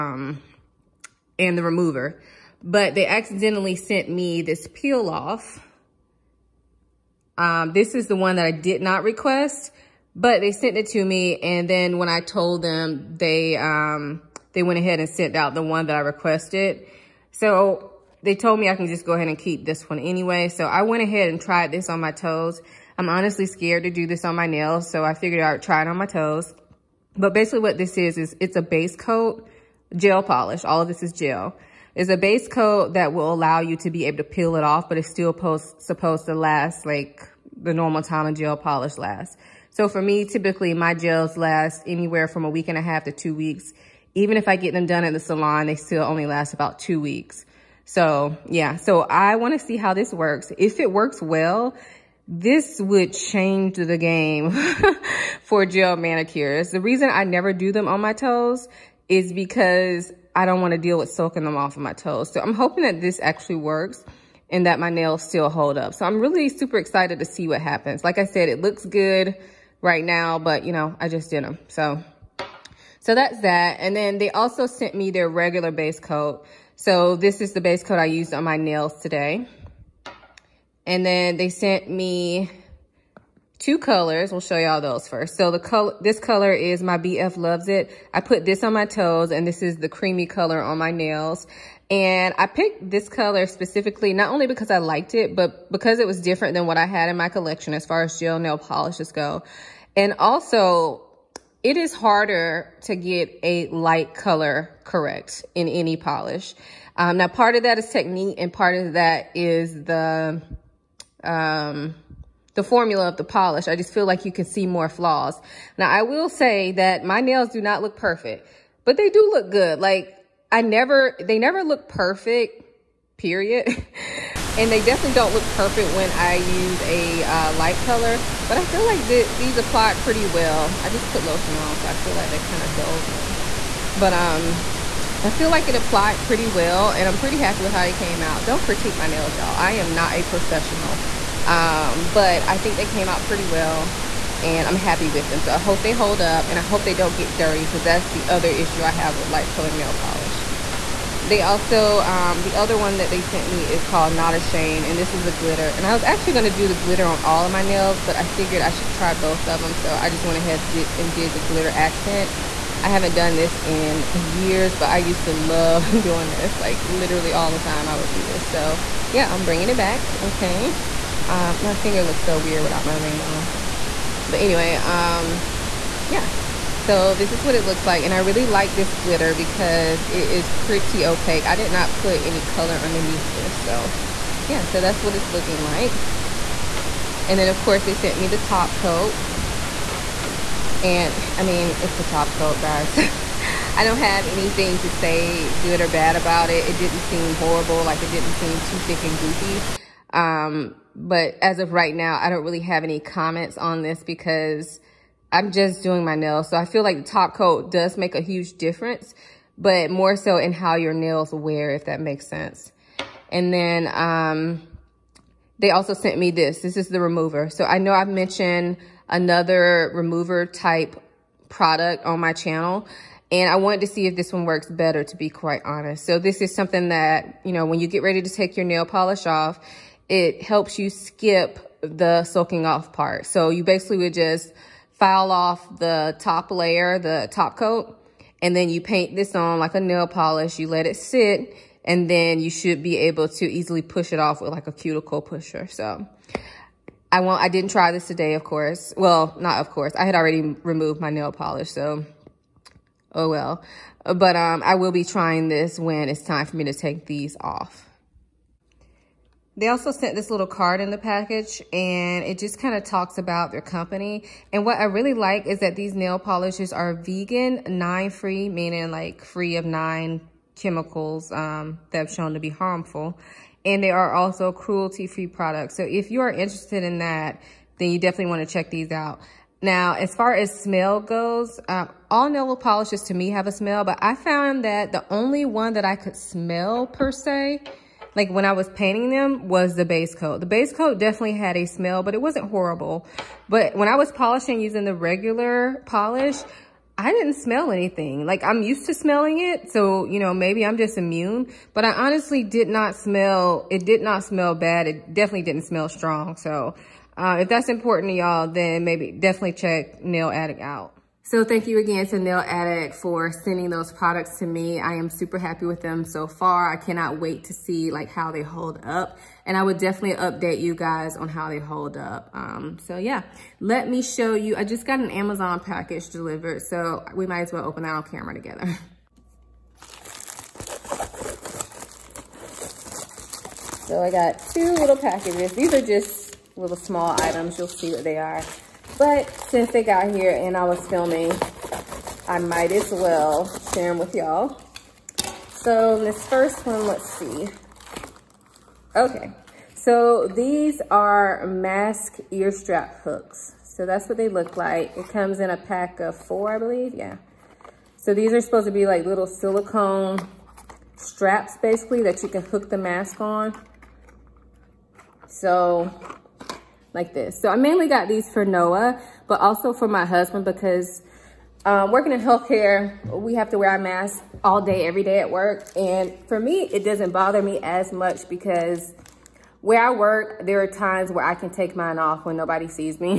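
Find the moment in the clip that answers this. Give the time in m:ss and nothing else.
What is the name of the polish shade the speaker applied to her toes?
1:26.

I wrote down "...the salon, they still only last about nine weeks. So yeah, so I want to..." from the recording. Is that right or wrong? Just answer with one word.
wrong.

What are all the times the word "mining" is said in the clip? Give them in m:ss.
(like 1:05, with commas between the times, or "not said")
not said.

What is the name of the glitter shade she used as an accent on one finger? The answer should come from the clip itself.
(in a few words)
Not Ashamed.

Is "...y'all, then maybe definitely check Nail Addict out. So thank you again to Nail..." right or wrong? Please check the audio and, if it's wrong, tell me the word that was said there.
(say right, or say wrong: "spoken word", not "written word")
right.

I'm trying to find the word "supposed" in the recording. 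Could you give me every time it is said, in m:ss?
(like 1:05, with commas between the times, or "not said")
0:35, 5:58.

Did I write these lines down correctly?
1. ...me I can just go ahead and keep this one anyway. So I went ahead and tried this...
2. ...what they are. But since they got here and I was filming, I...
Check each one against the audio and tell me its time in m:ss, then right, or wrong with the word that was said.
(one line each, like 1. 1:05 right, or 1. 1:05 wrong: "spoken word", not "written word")
1. 0:18 right
2. 5:37 right.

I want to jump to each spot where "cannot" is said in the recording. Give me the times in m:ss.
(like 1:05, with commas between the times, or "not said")
5:16.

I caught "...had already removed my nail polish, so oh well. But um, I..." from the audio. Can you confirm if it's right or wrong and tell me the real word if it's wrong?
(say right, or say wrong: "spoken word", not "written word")
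right.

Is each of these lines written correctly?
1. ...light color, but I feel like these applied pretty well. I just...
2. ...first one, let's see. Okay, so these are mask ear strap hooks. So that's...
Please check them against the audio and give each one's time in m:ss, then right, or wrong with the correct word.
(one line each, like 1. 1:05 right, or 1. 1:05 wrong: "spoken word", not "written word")
1. 2:07 right
2. 5:46 right.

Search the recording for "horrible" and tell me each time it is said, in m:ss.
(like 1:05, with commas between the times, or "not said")
3:17, 4:52.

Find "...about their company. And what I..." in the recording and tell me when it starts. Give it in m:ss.
4:23.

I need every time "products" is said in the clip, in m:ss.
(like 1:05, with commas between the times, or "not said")
3:41, 4:35, 5:13.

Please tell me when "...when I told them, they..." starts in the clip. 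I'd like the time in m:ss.
0:11.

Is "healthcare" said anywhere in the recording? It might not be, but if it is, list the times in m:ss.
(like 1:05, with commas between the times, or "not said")
6:12.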